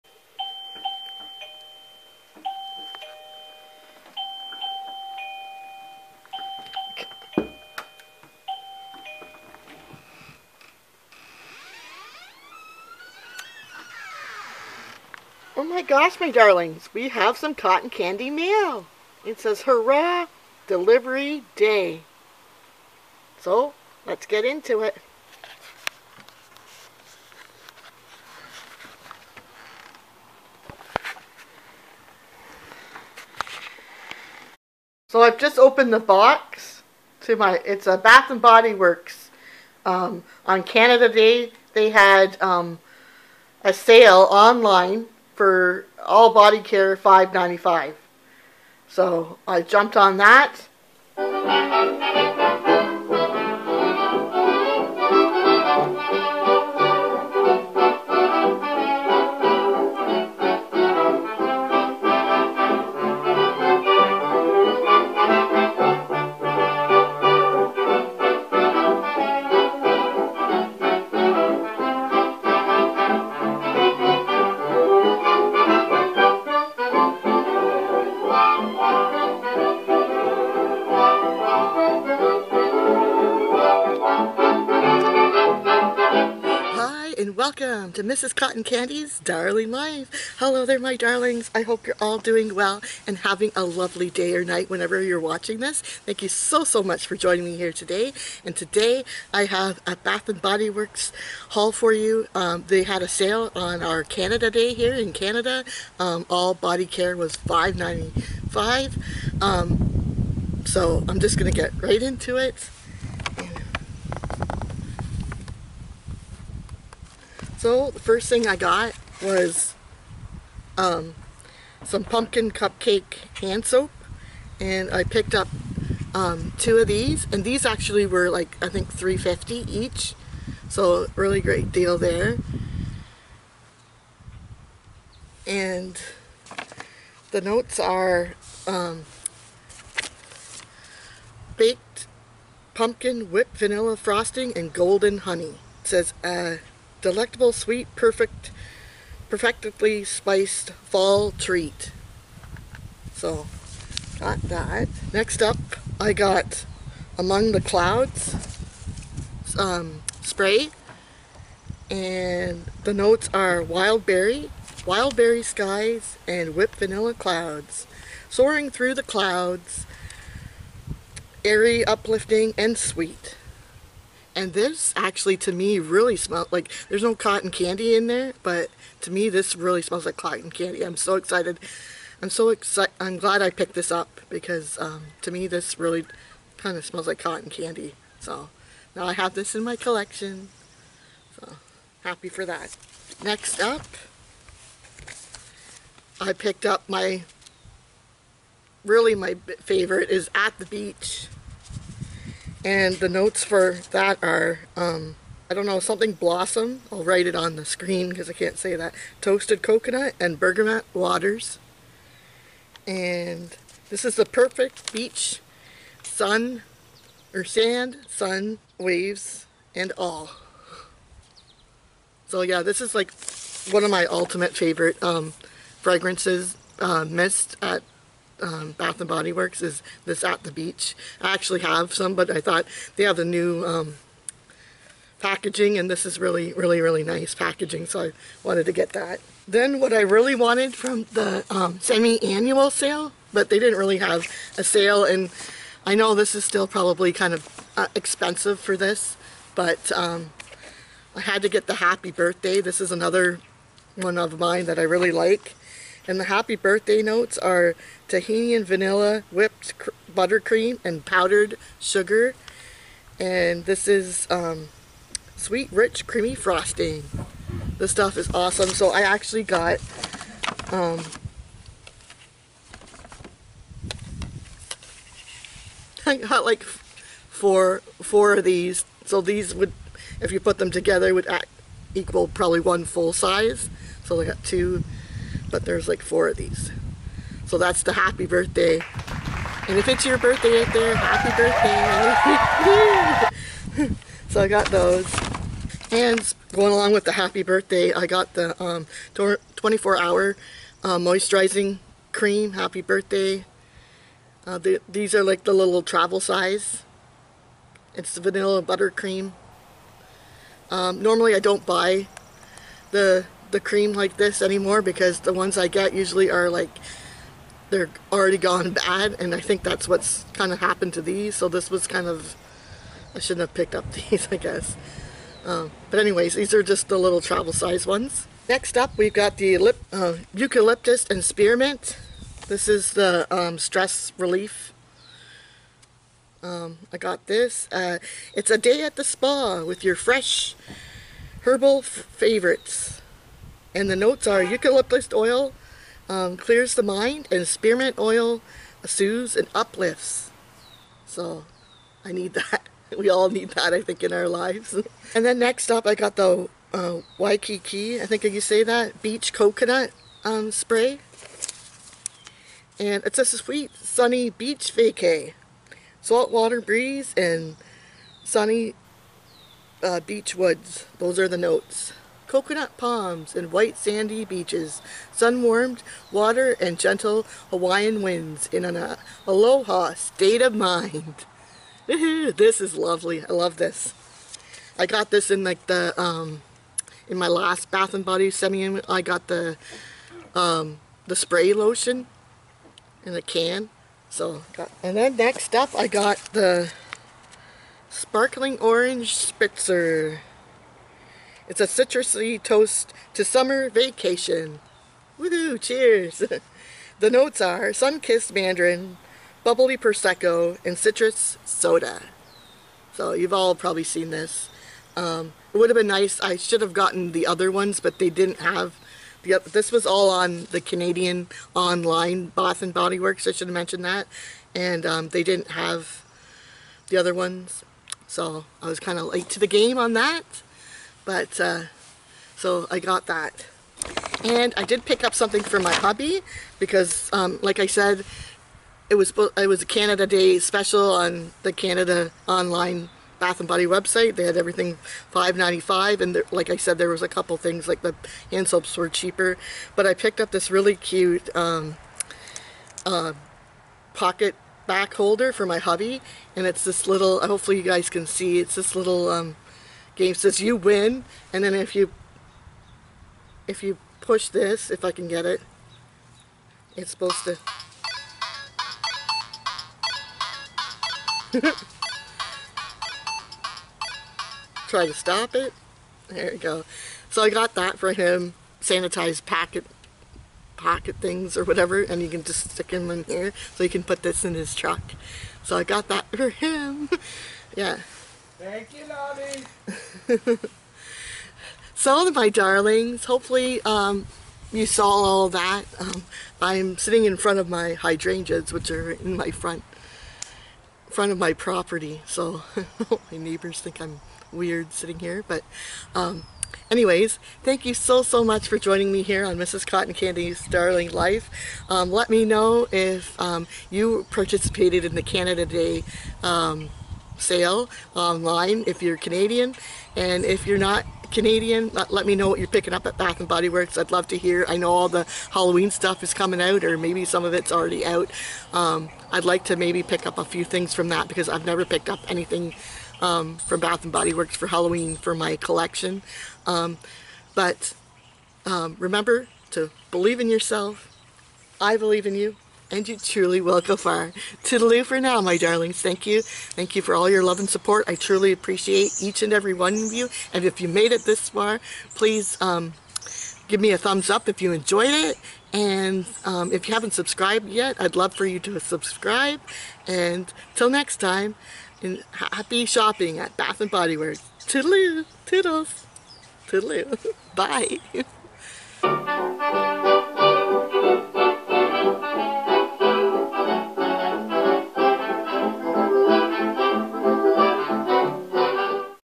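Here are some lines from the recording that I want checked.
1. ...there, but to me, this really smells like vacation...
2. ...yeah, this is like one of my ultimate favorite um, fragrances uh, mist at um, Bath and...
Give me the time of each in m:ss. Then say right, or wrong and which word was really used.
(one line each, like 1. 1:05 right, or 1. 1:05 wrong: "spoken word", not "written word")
1. 2:58 wrong: "cotton", not "vacation"
2. 3:42 right.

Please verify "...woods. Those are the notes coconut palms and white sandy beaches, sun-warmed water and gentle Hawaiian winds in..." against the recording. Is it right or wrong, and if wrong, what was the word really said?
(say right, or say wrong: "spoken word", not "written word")
right.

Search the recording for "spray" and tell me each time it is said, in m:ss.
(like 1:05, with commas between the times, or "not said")
2:40, 6:00, 6:31.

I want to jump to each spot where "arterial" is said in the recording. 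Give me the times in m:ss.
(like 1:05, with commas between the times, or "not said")
not said.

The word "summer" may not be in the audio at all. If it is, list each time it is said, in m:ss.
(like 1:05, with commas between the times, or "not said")
6:43.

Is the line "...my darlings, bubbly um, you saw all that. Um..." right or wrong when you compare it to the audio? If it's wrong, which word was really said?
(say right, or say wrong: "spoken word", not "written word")
wrong: "hopefully", not "bubbly".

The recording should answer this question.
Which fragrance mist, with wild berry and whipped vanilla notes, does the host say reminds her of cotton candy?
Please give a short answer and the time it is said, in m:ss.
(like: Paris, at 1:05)
Among the Clouds, at 2:37.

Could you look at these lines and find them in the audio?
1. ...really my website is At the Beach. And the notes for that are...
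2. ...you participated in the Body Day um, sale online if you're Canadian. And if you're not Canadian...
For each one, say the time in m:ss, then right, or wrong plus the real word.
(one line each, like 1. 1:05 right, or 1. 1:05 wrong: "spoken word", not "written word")
1. 3:18 wrong: "favorite", not "website"
2. 8:33 wrong: "Canada", not "Body".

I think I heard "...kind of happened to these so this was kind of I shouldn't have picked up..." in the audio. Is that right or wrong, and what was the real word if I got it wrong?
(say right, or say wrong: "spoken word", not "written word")
right.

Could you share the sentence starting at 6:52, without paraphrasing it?
So you've all probably seen this.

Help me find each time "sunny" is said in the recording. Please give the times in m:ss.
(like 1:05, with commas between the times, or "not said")
6:03, 6:08.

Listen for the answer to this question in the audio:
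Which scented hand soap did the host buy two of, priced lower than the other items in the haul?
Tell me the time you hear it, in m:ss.
2:02.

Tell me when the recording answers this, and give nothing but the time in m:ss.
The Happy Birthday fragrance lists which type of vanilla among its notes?
4:18.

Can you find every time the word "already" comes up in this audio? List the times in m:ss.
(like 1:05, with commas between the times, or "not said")
5:18, 8:47.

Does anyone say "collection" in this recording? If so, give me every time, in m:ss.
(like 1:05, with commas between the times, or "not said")
3:09, 8:55.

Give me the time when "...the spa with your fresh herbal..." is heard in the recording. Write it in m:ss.
5:38.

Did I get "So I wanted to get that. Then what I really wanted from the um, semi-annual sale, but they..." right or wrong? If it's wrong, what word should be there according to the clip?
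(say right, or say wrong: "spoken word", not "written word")
right.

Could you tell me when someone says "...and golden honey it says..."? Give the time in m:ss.
2:24.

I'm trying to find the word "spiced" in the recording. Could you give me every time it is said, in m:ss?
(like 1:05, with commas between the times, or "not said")
2:30.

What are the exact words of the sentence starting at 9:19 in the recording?
And till next time, and happy shopping at Bath & Body Works.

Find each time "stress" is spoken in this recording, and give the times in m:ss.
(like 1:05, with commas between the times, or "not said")
5:33.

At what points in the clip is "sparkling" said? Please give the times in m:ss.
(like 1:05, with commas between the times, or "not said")
6:37.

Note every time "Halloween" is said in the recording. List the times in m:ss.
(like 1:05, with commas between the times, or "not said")
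8:45, 8:54.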